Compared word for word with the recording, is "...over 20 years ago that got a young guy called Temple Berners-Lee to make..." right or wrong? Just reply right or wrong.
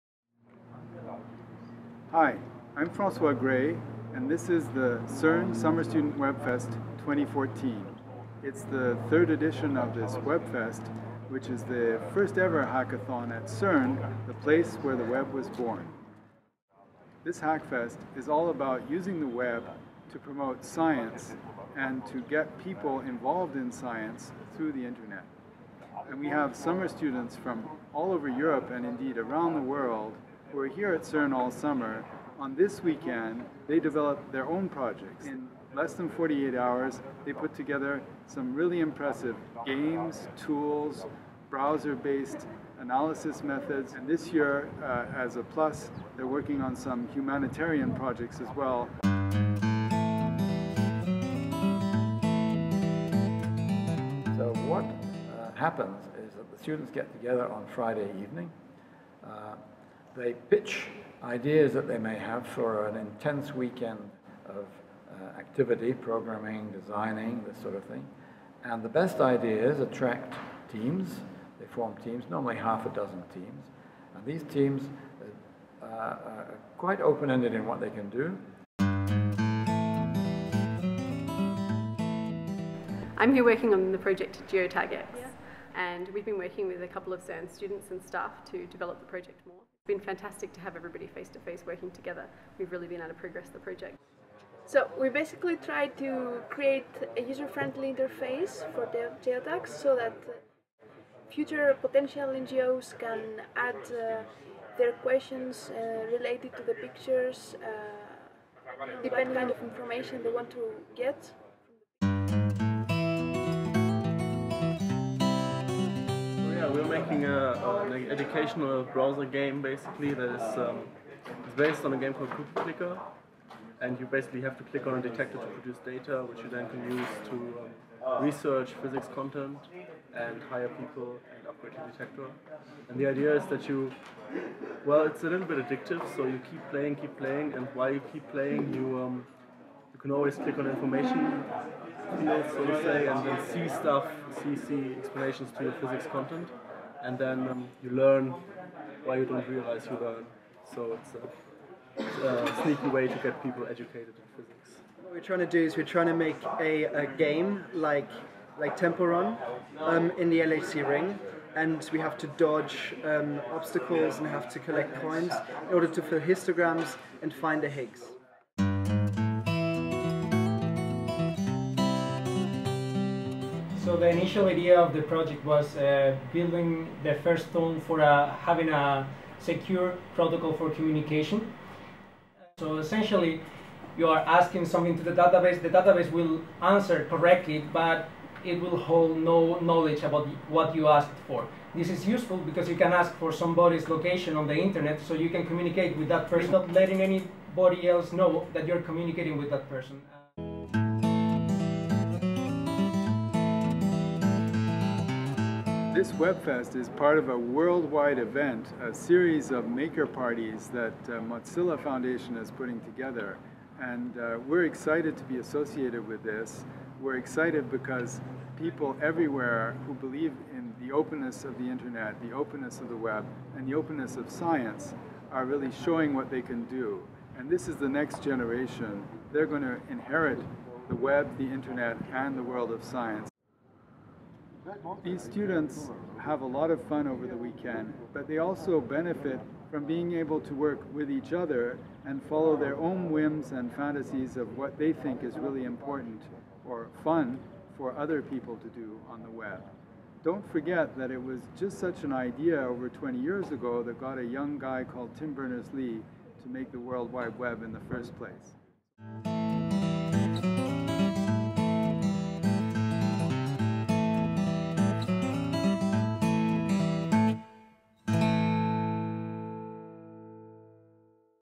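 wrong.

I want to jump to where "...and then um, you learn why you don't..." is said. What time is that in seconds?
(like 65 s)
147 s.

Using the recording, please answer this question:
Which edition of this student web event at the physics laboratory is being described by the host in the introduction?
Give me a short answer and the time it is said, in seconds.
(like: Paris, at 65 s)
third, at 9 s.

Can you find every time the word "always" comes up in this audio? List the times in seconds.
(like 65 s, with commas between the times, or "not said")
140 s.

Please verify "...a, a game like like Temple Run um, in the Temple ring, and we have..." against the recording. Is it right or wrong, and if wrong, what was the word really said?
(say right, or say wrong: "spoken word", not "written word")
wrong: "LHC", not "Temple".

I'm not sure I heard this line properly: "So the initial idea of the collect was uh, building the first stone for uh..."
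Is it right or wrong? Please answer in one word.
wrong.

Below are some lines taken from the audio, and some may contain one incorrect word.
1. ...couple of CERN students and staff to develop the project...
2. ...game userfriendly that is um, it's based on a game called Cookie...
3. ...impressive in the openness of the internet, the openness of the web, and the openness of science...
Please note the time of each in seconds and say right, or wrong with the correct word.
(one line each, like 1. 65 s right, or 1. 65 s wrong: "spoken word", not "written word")
1. 86 s right
2. 119 s wrong: "basically", not "userfriendly"
3. 219 s wrong: "believe", not "impressive".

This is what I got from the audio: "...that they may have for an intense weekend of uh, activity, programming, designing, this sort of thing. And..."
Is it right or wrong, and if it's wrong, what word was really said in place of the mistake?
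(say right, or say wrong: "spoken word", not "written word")
right.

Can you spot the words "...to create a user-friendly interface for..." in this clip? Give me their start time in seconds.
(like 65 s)
95 s.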